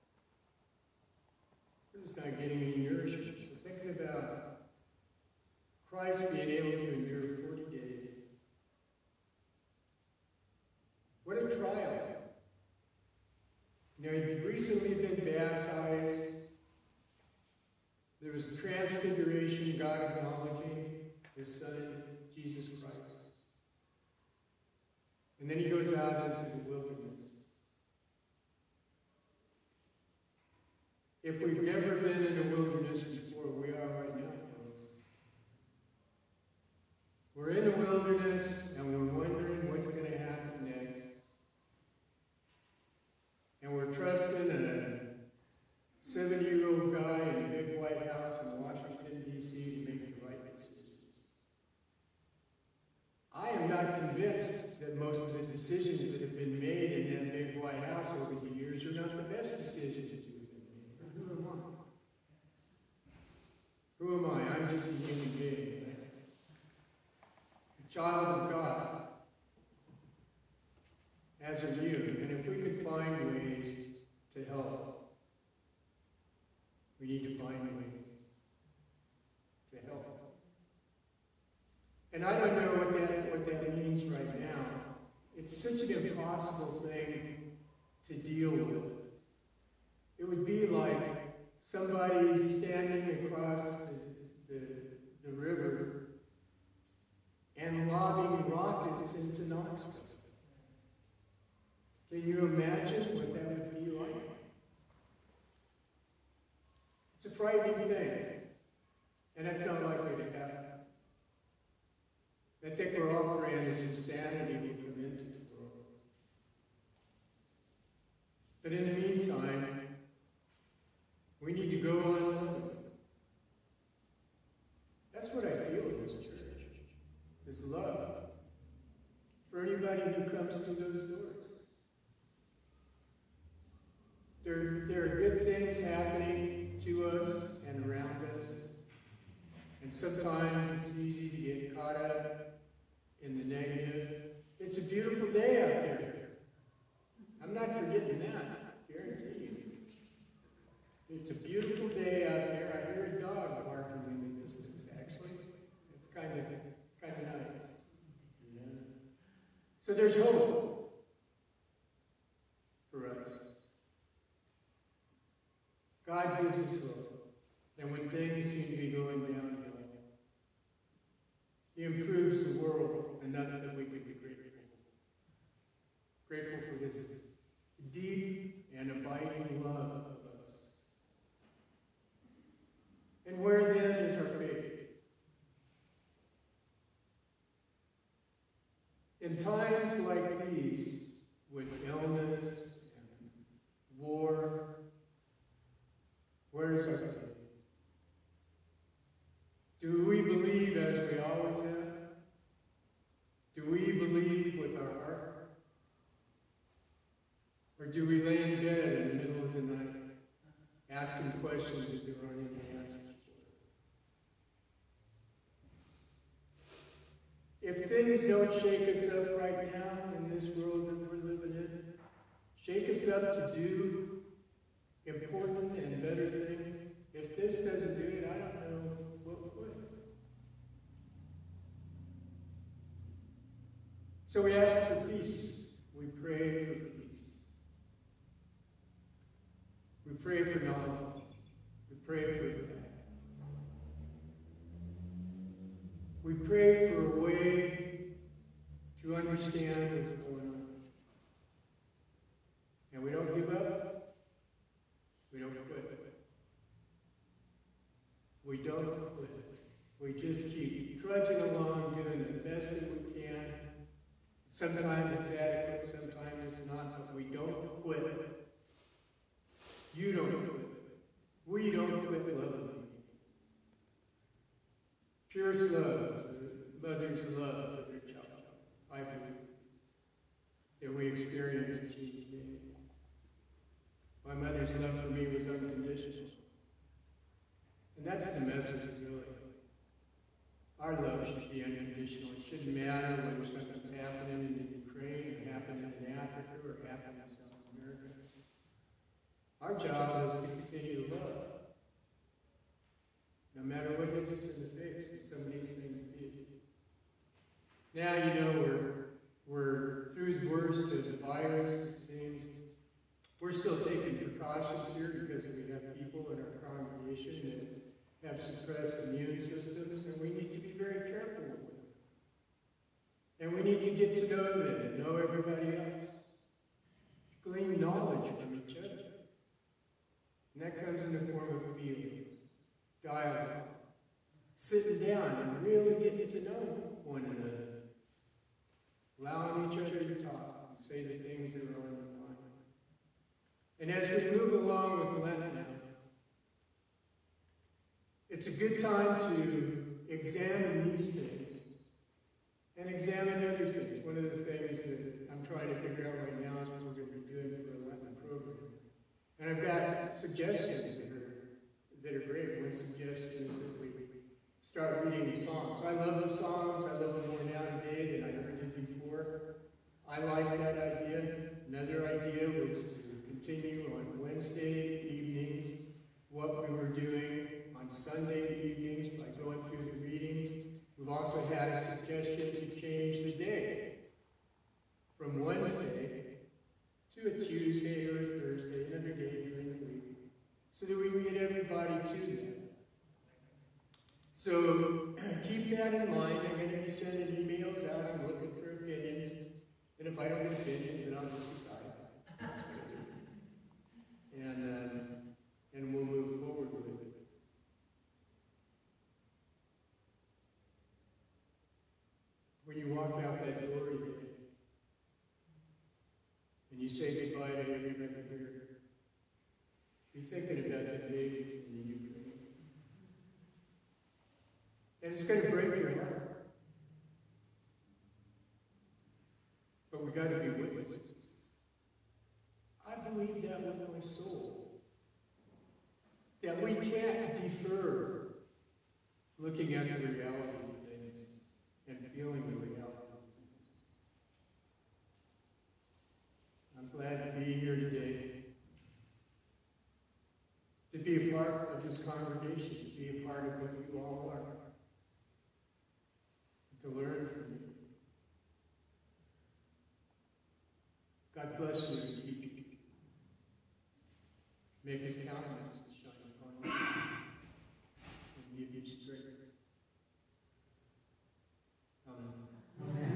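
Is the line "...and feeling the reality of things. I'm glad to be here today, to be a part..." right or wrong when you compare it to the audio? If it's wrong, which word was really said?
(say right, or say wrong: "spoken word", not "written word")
right.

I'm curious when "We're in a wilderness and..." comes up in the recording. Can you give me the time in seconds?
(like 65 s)
37 s.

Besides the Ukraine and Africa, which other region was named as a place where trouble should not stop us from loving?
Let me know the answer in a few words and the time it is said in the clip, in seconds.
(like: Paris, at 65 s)
South America, at 297 s.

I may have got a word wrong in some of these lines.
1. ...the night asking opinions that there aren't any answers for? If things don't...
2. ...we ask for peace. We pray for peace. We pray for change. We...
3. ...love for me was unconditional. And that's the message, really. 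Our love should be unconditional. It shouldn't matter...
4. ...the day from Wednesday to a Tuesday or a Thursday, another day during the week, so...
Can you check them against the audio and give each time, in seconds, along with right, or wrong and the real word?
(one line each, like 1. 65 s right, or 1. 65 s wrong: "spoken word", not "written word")
1. 209 s wrong: "questions", not "opinions"
2. 234 s wrong: "knowledge", not "change"
3. 284 s right
4. 383 s right.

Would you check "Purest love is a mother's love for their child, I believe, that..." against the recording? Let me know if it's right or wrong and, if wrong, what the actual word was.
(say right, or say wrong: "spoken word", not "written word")
right.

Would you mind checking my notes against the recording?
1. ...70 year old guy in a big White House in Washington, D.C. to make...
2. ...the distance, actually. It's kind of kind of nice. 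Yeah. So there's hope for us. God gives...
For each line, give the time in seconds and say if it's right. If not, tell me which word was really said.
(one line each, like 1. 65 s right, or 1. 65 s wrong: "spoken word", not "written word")
1. 46 s right
2. 154 s right.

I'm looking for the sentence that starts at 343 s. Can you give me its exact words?
And as we move along with Lent now, it's a good time to examine these things and examine other things.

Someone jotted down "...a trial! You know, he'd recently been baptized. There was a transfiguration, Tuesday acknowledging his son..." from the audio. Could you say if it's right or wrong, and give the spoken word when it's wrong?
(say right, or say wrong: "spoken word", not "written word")
wrong: "God", not "Tuesday".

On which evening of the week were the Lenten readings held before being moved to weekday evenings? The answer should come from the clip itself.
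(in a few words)
Sunday.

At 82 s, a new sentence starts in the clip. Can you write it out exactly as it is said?
And I don't know what that, what that means right now.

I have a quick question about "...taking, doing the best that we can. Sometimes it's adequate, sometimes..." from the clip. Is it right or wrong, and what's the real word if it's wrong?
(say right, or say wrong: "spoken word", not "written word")
wrong: "along", not "taking".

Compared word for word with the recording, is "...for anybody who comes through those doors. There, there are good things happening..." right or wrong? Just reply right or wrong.
right.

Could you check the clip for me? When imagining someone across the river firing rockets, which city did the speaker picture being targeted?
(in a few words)
Knoxville.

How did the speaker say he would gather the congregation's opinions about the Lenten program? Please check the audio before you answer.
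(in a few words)
emails.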